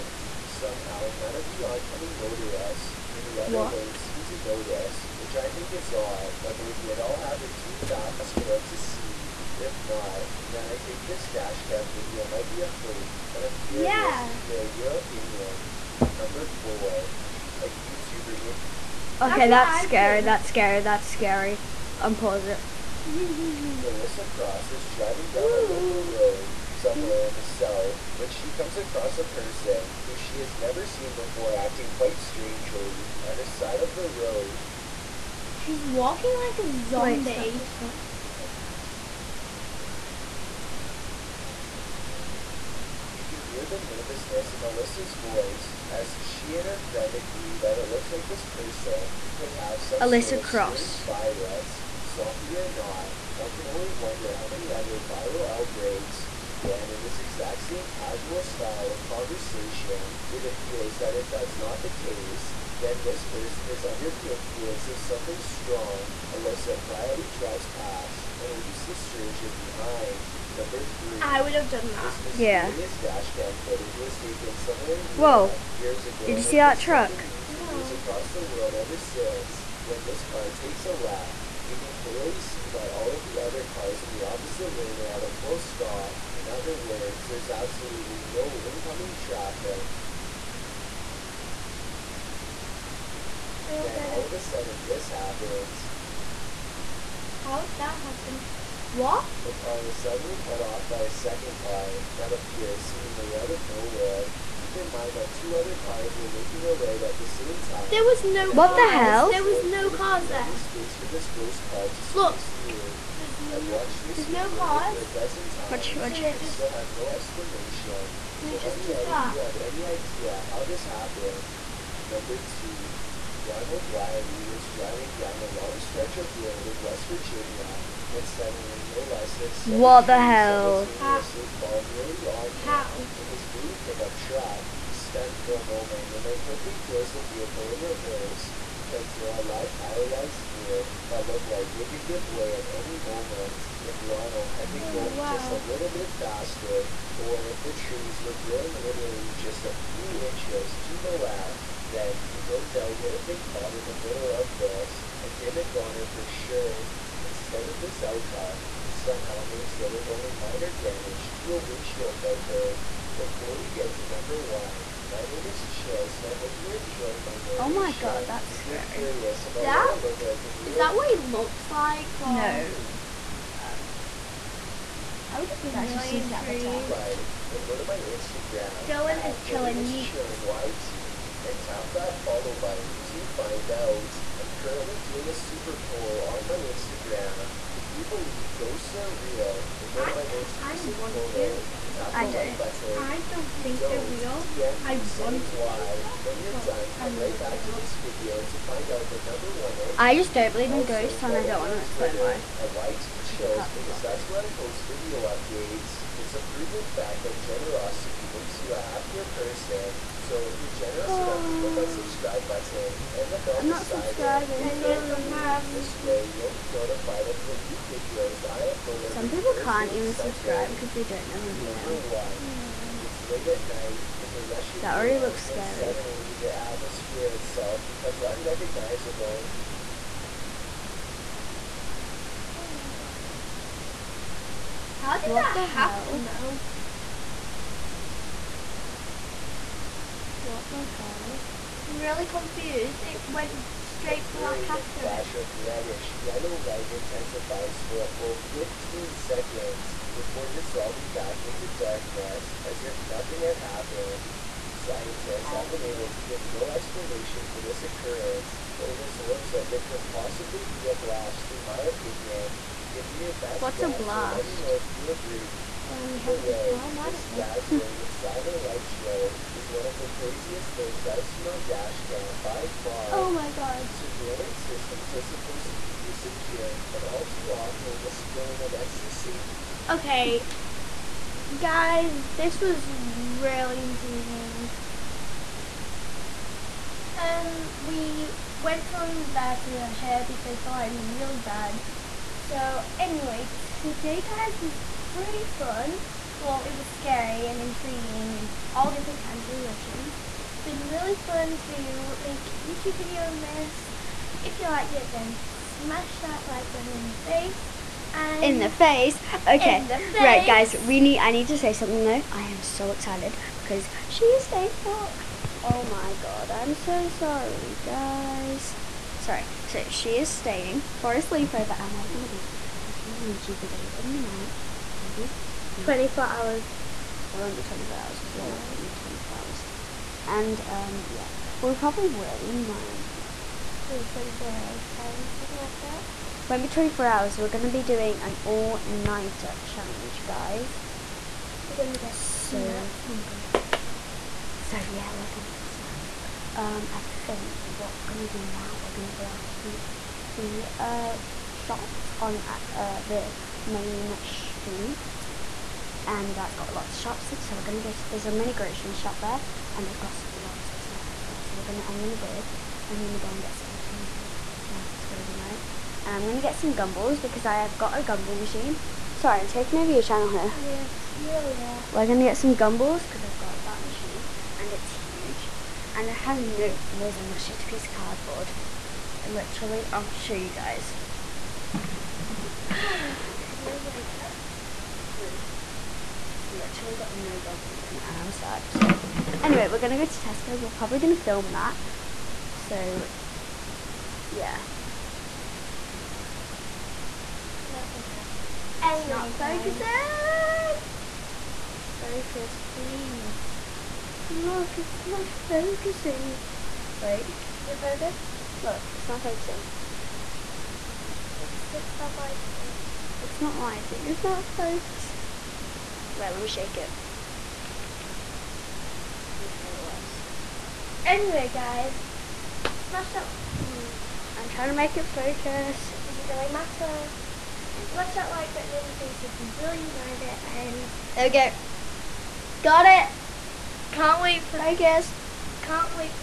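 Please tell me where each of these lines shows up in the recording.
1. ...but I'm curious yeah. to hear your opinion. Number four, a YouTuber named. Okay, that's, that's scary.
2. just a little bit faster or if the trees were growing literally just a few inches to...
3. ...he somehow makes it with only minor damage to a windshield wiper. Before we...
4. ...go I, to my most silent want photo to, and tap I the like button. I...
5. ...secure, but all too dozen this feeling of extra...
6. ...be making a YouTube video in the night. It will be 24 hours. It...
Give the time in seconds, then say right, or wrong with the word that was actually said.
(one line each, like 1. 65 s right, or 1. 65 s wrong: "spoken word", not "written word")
1. 13 s right
2. 145 s right
3. 158 s right
4. 189 s wrong: "recent", not "silent"
5. 276 s wrong: "often", not "dozen"
6. 322 s right.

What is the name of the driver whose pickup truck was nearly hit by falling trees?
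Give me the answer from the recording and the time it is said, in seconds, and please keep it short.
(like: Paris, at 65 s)
Ronald Wiley, at 123 s.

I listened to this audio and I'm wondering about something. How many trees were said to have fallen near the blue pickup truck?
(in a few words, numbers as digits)
7.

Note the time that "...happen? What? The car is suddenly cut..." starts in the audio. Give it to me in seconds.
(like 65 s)
97 s.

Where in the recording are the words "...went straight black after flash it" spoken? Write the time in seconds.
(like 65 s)
243 s.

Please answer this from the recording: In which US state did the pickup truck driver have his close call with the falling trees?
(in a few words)
West Virginia.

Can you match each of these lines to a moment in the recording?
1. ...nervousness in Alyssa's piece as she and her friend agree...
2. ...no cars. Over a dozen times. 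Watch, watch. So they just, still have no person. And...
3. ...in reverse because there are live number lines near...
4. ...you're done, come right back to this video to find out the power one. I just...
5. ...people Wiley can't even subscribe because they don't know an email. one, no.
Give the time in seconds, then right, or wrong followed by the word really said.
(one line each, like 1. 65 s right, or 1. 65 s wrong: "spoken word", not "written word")
1. 43 s wrong: "voice", not "piece"
2. 114 s wrong: "explanation", not "person"
3. 137 s wrong: "power", not "number"
4. 196 s wrong: "number", not "power"
5. 219 s wrong: "Thursday", not "Wiley".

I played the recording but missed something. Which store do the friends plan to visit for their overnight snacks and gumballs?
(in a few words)
Tesco.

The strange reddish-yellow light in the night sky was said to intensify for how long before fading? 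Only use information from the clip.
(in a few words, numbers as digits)
15 seconds.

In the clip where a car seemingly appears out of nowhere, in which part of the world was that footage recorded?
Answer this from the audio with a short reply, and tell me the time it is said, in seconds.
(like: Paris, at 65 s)
Europe, at 75 s.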